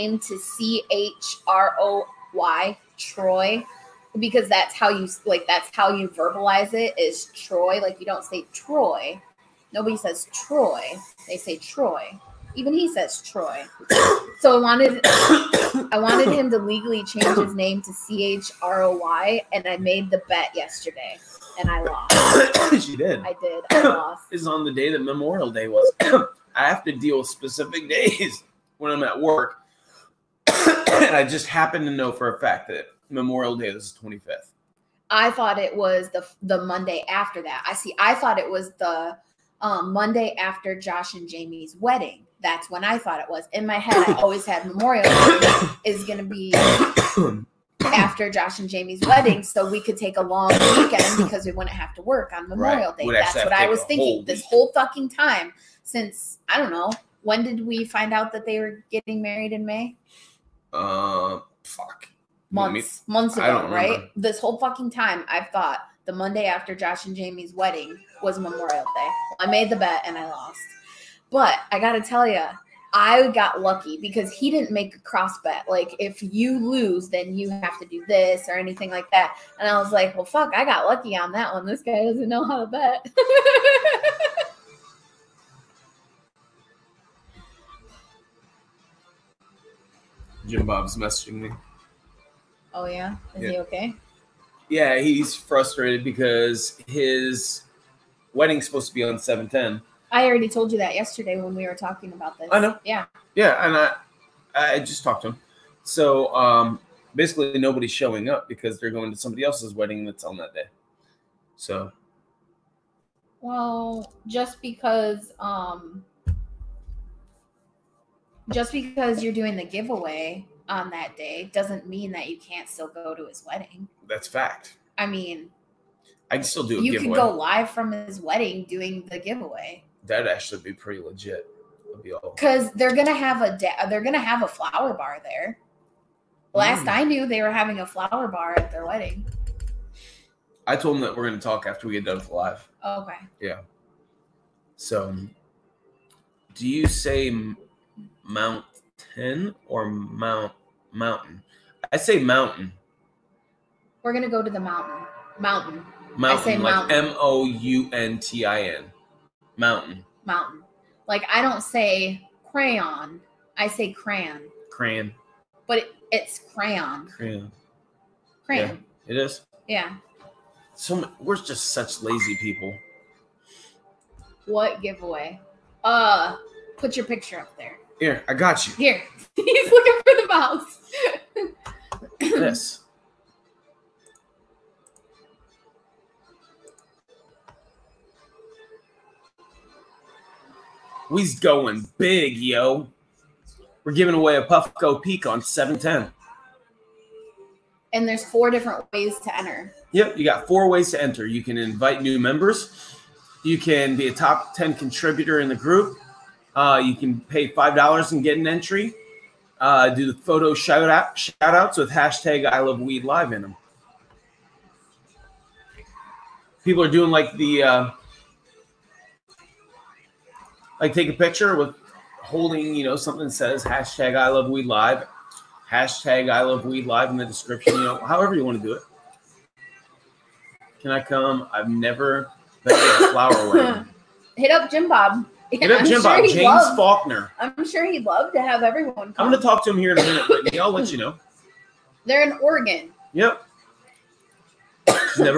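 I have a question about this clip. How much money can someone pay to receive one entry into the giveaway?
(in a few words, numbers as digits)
$5.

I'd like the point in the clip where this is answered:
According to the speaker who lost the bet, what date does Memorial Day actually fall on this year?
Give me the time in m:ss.
0:33.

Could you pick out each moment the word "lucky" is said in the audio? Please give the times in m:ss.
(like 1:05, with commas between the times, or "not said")
1:13, 1:20.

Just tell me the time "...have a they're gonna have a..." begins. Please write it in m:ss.
2:13.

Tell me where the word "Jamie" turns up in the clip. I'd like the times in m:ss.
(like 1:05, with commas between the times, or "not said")
0:41, 0:48, 1:07.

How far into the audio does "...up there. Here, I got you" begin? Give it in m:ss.
2:57.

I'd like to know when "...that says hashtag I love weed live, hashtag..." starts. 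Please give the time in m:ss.
3:43.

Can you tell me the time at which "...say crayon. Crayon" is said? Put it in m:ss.
2:43.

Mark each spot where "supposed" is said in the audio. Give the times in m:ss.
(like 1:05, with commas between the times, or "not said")
1:38.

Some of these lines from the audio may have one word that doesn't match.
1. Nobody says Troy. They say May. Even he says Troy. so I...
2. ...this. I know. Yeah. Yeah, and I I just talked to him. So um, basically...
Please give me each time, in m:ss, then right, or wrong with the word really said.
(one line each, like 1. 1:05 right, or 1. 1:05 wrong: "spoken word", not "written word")
1. 0:09 wrong: "Troy", not "May"
2. 1:42 right.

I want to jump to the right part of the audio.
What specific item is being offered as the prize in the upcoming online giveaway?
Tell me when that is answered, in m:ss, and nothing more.
3:14.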